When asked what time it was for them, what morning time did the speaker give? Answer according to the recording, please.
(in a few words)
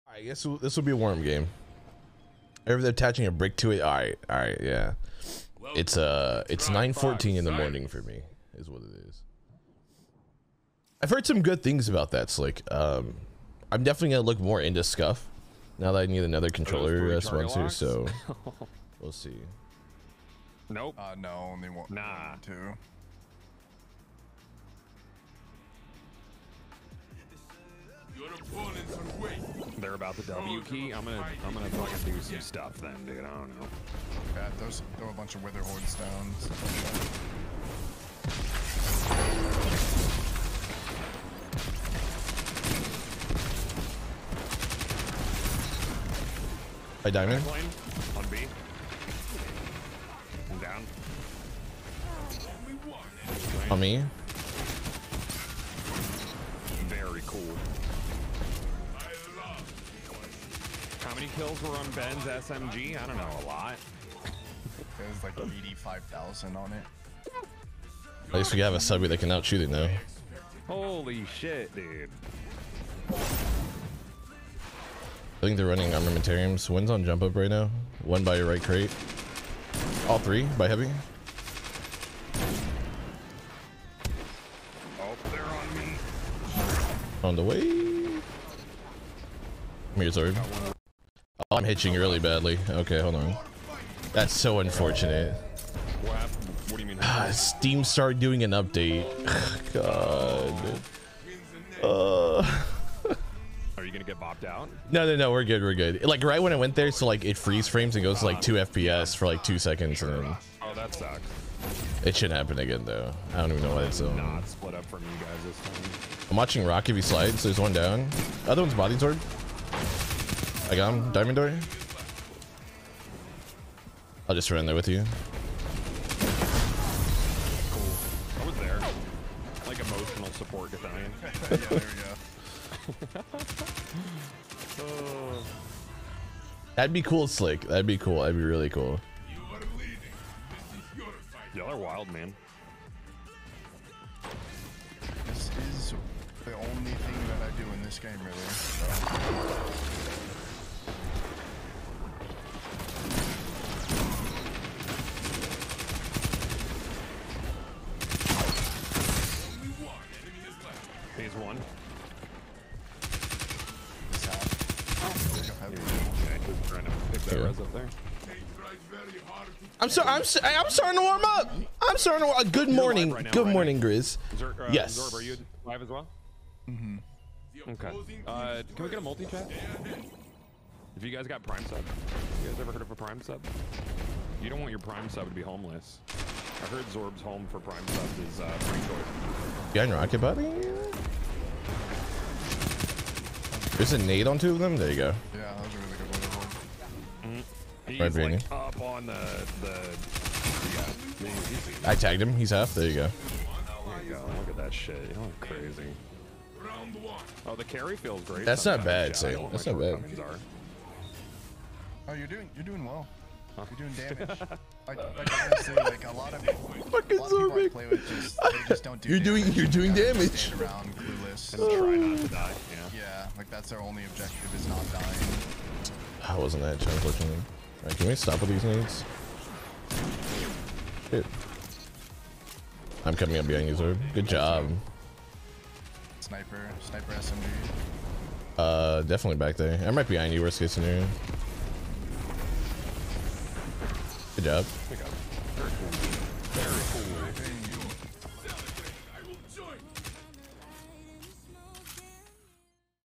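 9:14.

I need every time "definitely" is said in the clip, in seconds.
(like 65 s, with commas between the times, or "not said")
13 s, 239 s.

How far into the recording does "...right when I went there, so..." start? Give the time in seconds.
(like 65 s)
106 s.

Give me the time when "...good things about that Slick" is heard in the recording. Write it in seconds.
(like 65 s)
11 s.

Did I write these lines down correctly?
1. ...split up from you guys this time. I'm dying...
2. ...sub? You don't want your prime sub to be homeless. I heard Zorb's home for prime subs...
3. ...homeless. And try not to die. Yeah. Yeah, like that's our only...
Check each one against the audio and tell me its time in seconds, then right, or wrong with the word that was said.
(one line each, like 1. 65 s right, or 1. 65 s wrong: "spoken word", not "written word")
1. 114 s wrong: "watching", not "dying"
2. 183 s right
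3. 220 s wrong: "clueless", not "homeless".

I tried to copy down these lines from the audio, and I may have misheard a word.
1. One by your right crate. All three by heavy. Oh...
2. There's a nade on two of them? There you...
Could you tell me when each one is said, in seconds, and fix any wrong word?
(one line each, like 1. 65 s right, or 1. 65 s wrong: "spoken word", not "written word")
1. 78 s right
2. 193 s right.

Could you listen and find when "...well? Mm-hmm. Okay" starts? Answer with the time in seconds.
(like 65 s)
175 s.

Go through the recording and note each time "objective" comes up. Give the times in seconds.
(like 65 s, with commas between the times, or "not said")
224 s.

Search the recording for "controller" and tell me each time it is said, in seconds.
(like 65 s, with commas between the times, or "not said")
16 s.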